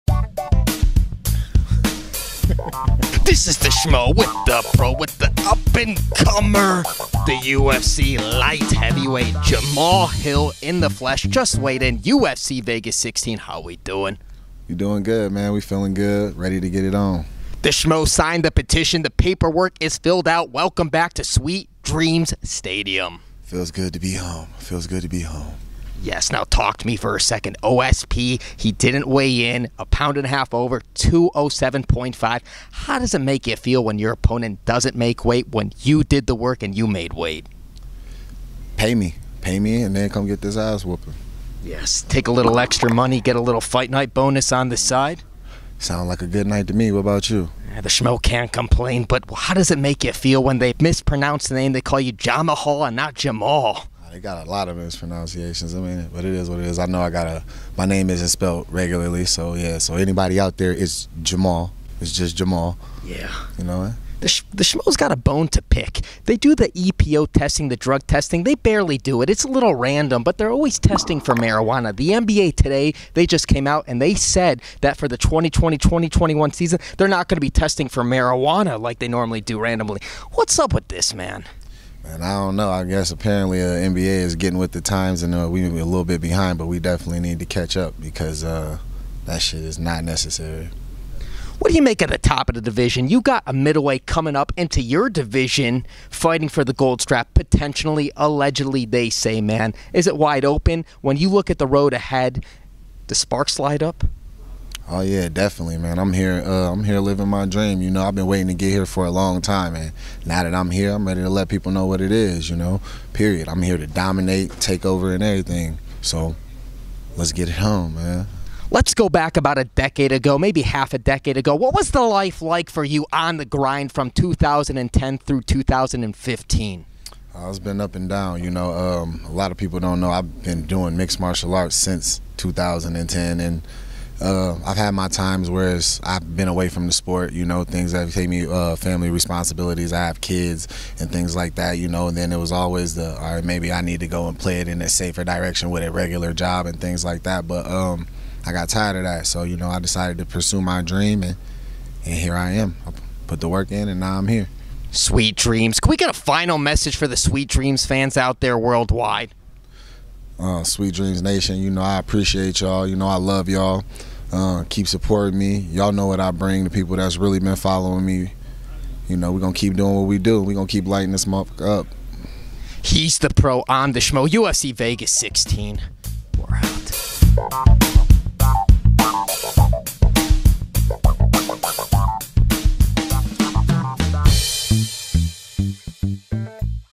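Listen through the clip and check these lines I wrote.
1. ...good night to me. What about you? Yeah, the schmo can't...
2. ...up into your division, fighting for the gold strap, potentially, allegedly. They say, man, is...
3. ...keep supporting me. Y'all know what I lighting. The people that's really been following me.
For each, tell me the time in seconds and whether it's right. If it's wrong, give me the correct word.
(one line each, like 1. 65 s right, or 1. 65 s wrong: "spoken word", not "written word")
1. 46 s right
2. 94 s right
3. 164 s wrong: "bring", not "lighting".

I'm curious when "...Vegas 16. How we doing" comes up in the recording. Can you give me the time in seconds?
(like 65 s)
12 s.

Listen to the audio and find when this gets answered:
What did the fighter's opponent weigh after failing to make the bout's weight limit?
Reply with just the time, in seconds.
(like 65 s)
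30 s.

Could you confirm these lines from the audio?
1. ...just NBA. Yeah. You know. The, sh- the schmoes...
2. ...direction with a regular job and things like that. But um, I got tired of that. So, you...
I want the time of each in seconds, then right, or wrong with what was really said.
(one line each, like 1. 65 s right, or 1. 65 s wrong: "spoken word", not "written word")
1. 62 s wrong: "Jamal", not "NBA"
2. 145 s right.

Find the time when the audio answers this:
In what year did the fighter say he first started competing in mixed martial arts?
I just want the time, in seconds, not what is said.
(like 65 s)
131 s.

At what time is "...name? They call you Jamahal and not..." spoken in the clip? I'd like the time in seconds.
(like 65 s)
51 s.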